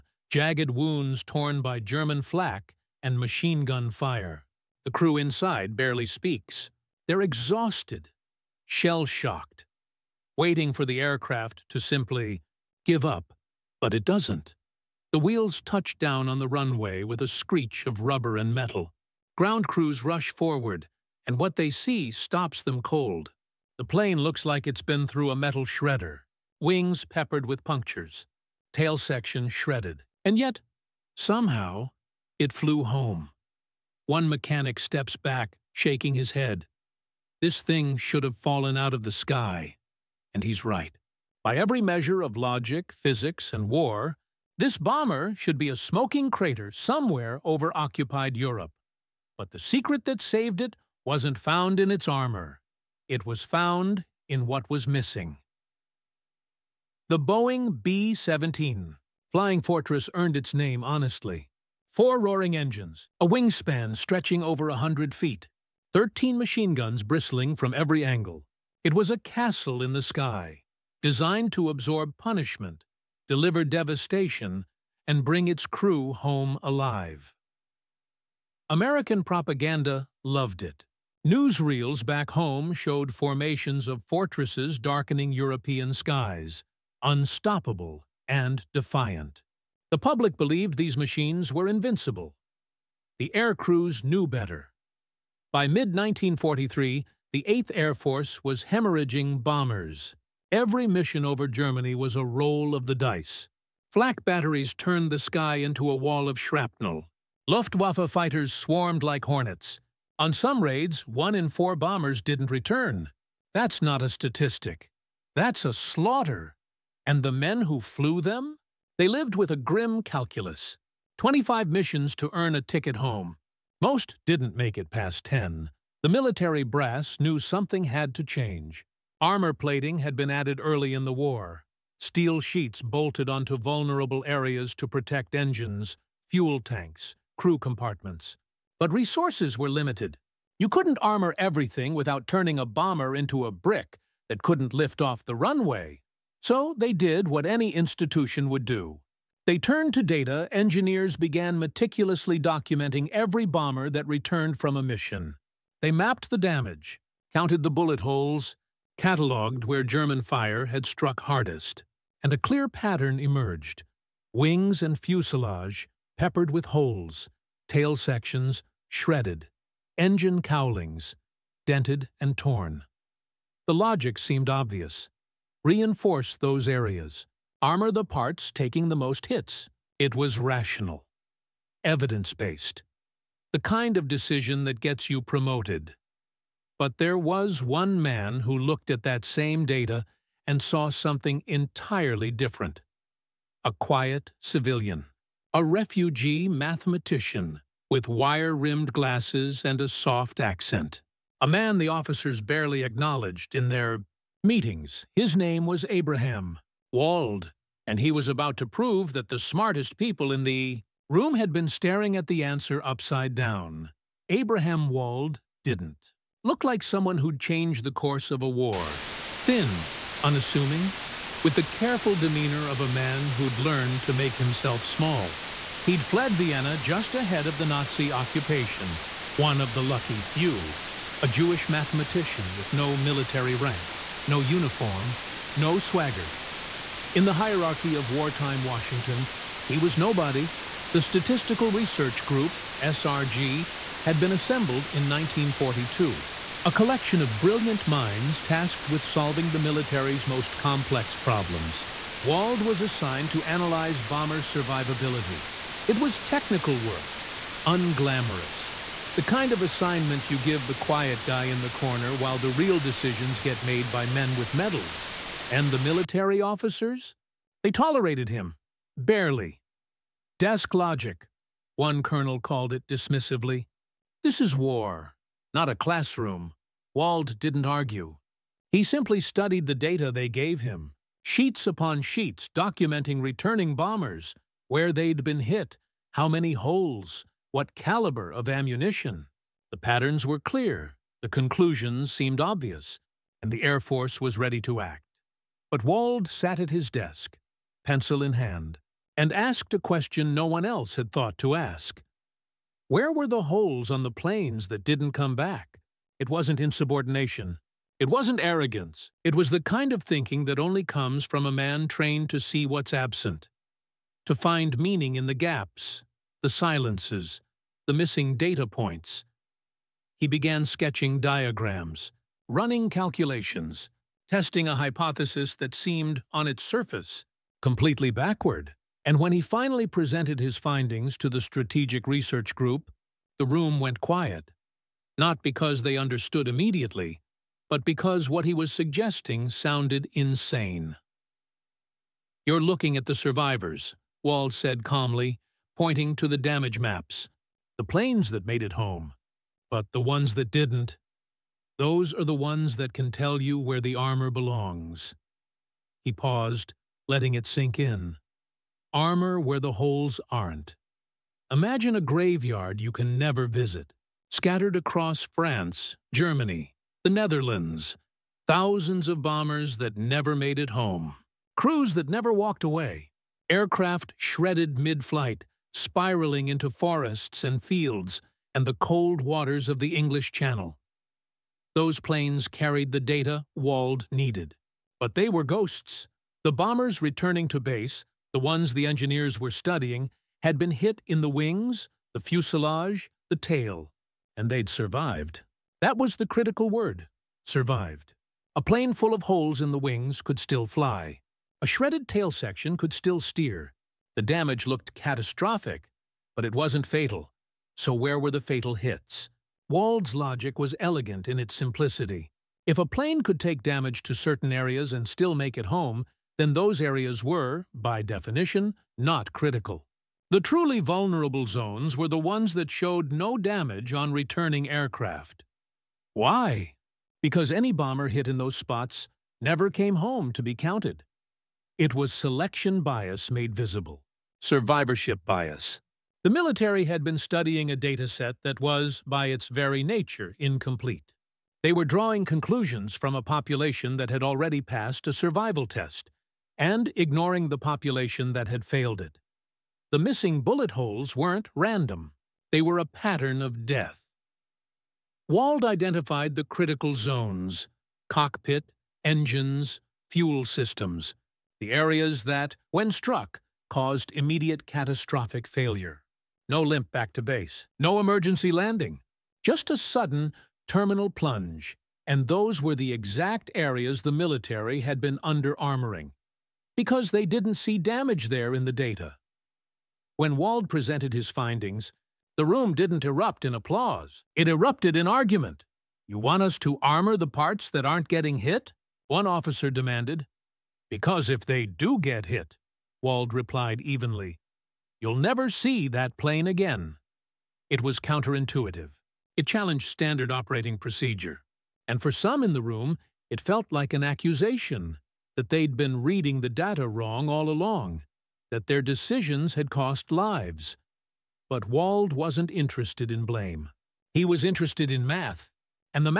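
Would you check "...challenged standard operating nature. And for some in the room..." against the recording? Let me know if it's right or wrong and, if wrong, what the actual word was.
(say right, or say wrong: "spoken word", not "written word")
wrong: "procedure", not "nature".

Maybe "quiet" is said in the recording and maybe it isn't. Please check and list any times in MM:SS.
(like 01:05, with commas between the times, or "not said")
03:13, 04:20, 05:34.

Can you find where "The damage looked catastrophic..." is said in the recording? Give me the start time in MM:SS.
06:44.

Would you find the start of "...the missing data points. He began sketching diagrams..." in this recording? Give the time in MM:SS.
05:17.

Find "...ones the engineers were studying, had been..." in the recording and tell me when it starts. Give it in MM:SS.
06:28.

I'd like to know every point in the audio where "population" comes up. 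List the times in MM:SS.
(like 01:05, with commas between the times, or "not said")
07:23, 07:27.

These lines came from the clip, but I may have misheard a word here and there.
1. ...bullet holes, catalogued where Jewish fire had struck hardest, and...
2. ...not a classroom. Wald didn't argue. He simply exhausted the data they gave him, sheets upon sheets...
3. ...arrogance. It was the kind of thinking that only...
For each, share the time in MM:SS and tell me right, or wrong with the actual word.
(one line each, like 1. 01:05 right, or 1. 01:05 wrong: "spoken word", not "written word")
1. 02:37 wrong: "German", not "Jewish"
2. 04:35 wrong: "studied", not "exhausted"
3. 05:08 right.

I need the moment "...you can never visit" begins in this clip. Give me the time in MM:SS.
06:02.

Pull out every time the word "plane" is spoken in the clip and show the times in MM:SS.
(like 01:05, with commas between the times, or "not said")
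00:23, 05:04, 05:47, 06:22, 06:38, 06:52, 08:16.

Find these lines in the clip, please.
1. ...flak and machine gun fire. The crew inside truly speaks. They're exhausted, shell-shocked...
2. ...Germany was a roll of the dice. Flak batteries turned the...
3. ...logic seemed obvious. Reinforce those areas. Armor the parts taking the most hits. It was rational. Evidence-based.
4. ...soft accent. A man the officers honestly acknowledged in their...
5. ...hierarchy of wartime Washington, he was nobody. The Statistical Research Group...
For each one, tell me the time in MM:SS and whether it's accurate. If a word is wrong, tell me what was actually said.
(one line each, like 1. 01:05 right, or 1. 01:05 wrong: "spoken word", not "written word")
1. 00:02 wrong: "barely", not "truly"
2. 01:41 right
3. 02:53 right
4. 03:19 wrong: "barely", not "honestly"
5. 03:57 right.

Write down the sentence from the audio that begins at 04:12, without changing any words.
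Wald was assigned to analyze bomber survivability.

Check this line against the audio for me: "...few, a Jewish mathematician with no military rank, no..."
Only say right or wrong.
right.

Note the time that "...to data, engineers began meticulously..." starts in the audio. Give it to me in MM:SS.
02:29.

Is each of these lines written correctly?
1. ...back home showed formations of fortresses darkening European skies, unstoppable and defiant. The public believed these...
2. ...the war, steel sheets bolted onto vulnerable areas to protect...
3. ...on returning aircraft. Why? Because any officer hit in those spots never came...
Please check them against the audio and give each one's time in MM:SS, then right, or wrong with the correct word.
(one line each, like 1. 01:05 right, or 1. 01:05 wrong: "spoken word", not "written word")
1. 01:22 right
2. 02:11 right
3. 07:03 wrong: "bomber", not "officer".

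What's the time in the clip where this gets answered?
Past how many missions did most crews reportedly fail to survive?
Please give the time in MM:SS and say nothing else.
02:05.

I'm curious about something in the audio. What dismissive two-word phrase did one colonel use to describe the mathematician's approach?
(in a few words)
Desk logic.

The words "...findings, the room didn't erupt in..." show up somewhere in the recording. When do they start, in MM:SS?
08:01.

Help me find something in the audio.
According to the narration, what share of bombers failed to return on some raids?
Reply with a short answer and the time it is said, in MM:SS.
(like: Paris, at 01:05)
one in four, at 01:51.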